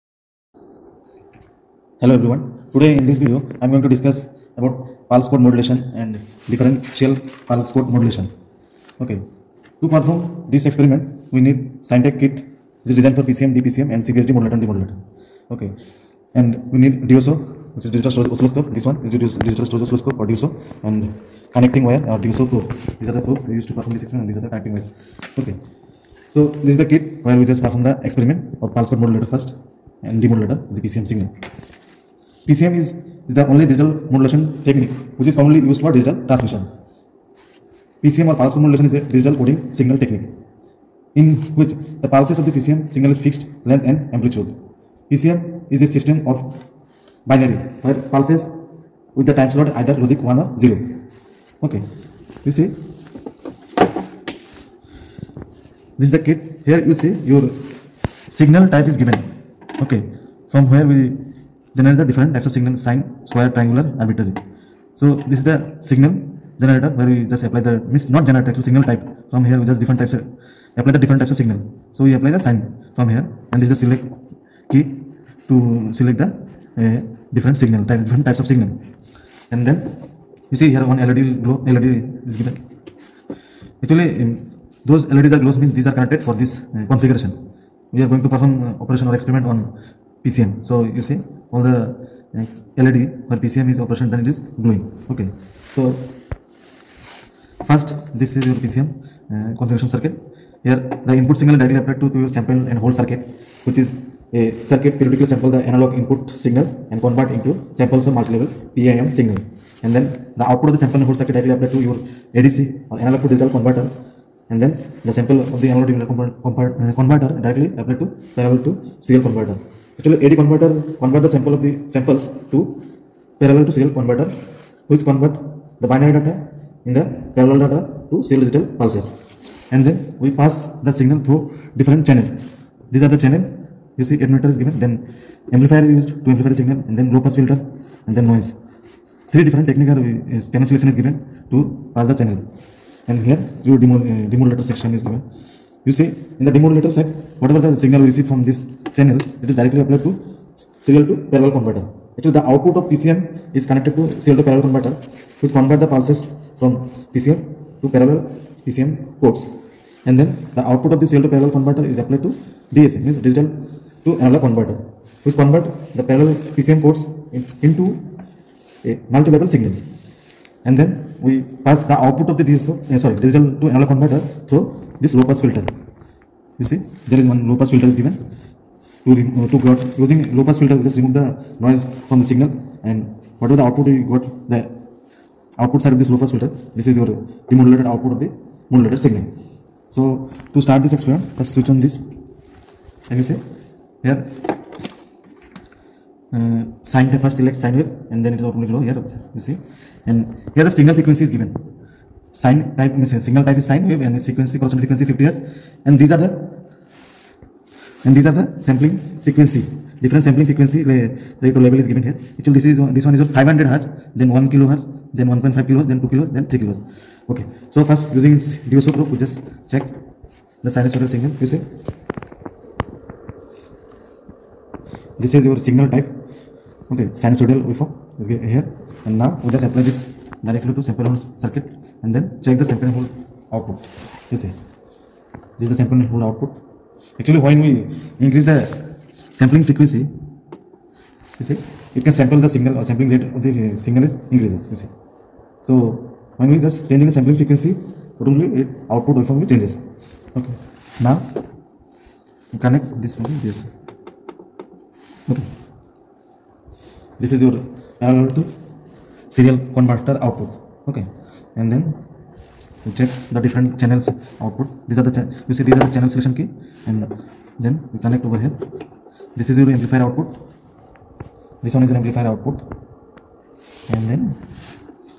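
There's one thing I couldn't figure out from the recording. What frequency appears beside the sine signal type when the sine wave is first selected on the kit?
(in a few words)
50 hertz.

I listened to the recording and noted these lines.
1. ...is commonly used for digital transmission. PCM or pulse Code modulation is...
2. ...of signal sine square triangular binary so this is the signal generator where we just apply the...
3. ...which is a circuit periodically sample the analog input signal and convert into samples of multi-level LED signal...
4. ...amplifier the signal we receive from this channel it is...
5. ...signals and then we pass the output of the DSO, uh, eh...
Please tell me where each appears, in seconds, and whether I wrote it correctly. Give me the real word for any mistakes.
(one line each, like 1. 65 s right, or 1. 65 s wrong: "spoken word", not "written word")
1. 35 s right
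2. 62 s wrong: "arbitrary", not "binary"
3. 103 s wrong: "PAM", not "LED"
4. 147 s wrong: "whatever", not "amplifier"
5. 169 s right.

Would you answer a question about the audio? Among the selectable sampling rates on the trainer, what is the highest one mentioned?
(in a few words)
3 kilohertz.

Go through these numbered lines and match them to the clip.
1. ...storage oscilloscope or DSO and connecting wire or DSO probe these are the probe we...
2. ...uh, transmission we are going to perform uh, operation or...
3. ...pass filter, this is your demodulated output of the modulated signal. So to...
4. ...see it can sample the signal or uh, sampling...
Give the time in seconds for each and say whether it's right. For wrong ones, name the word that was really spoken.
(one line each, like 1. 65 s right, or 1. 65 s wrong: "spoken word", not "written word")
1. 19 s right
2. 86 s wrong: "configuration", not "transmission"
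3. 186 s right
4. 241 s right.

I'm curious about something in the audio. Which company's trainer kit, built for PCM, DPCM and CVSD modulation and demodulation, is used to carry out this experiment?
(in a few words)
Scientech.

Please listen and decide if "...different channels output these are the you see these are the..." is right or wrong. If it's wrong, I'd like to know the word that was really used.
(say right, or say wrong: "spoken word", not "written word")
right.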